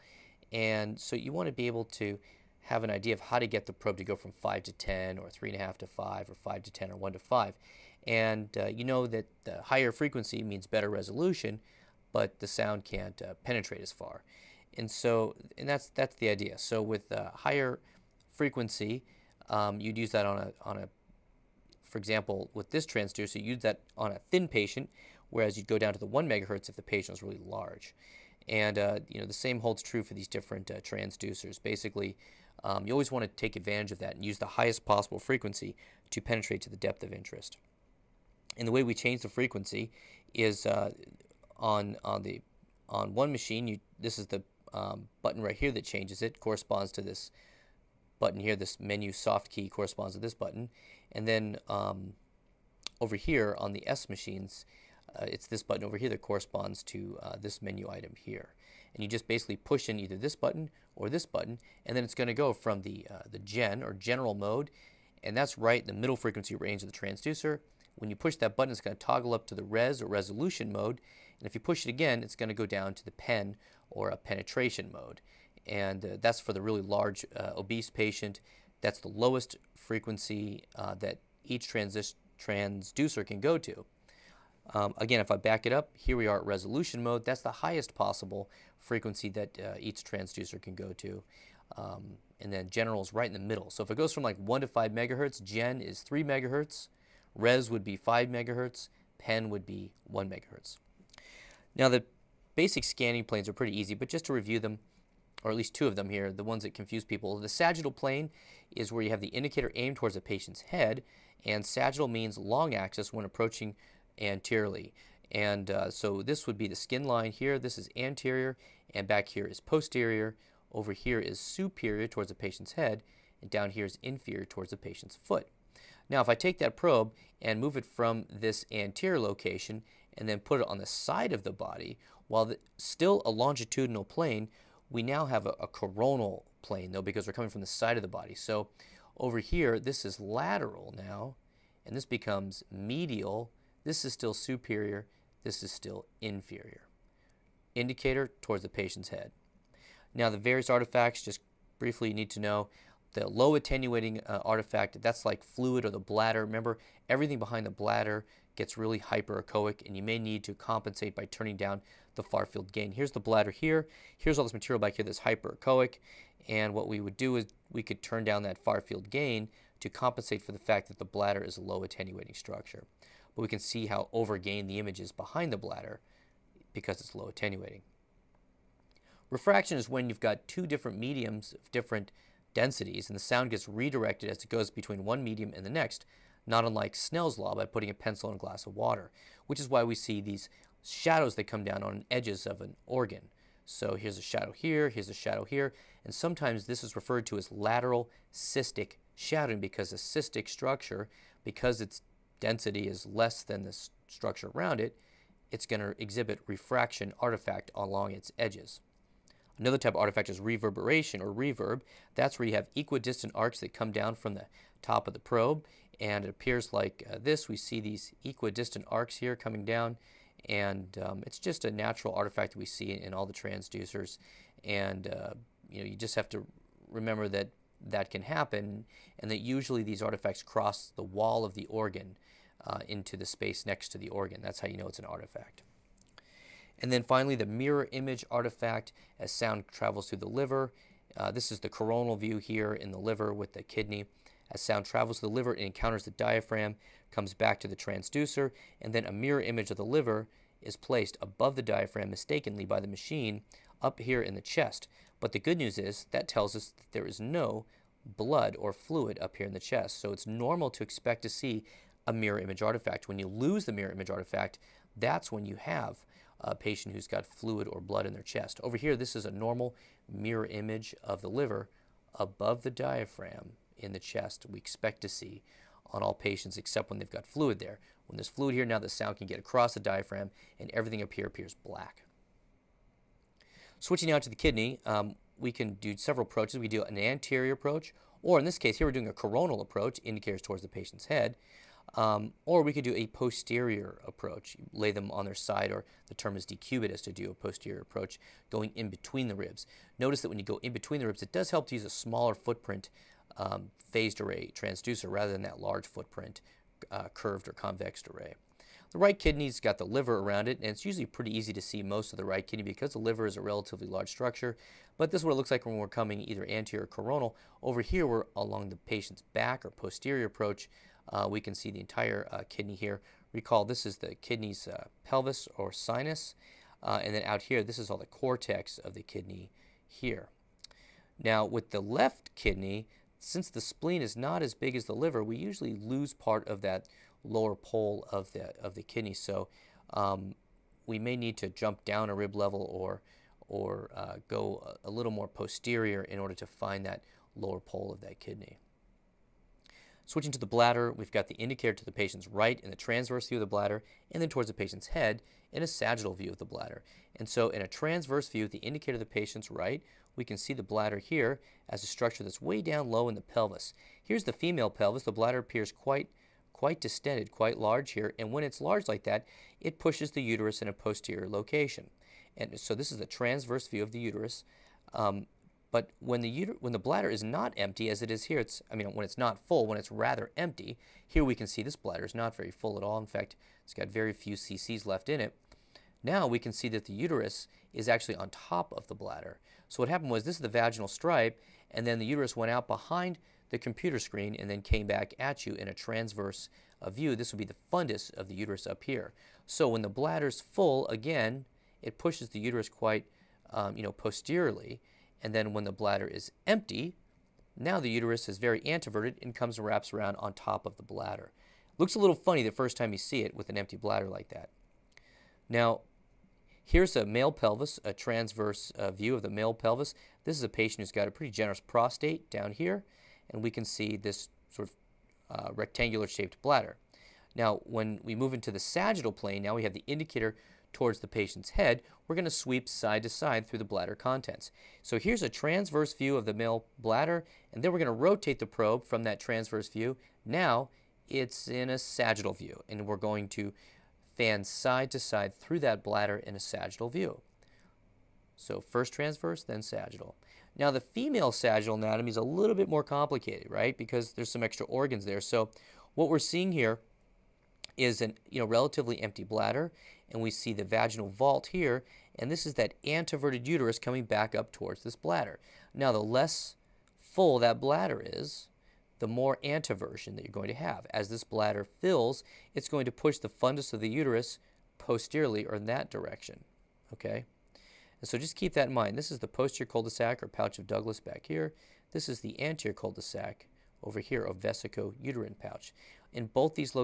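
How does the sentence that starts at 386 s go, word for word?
Now we can see that the uterus is actually on top of the bladder.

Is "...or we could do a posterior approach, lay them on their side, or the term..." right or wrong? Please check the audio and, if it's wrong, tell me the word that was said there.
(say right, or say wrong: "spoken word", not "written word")
right.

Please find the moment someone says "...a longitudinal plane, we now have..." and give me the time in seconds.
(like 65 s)
133 s.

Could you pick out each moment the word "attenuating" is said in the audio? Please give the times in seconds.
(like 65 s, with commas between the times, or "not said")
153 s, 171 s, 177 s.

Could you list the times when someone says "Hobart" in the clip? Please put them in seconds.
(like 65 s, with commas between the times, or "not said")
not said.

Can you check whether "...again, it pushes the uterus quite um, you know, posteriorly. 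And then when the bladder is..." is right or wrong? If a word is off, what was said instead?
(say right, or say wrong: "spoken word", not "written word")
right.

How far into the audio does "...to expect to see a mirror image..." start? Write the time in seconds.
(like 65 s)
260 s.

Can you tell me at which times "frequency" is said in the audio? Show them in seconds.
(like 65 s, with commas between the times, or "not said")
9 s, 18 s, 35 s, 39 s, 66 s, 79 s, 88 s.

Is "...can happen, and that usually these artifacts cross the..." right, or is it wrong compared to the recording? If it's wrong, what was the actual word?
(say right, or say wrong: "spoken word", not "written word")
right.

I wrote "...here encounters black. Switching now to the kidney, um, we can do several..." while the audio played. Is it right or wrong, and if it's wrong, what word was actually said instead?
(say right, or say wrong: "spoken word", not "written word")
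wrong: "appears", not "encounters".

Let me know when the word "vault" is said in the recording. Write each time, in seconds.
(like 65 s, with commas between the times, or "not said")
461 s.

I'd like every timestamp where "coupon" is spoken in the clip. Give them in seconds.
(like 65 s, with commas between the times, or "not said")
not said.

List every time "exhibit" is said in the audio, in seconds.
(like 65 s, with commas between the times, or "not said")
205 s.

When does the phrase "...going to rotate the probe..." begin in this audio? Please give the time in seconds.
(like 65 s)
437 s.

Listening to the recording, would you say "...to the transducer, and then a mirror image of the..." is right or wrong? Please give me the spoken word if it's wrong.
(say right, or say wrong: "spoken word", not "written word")
right.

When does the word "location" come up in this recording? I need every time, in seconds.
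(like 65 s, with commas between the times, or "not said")
129 s, 371 s.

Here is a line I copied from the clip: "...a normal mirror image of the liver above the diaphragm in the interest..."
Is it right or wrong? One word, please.
wrong.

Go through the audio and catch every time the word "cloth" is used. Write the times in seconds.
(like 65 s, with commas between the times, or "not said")
not said.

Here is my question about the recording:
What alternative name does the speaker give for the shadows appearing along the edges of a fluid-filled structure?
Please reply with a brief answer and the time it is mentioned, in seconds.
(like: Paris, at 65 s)
lateral cystic shadowing, at 197 s.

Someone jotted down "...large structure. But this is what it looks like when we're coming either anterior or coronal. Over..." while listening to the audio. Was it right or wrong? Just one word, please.
right.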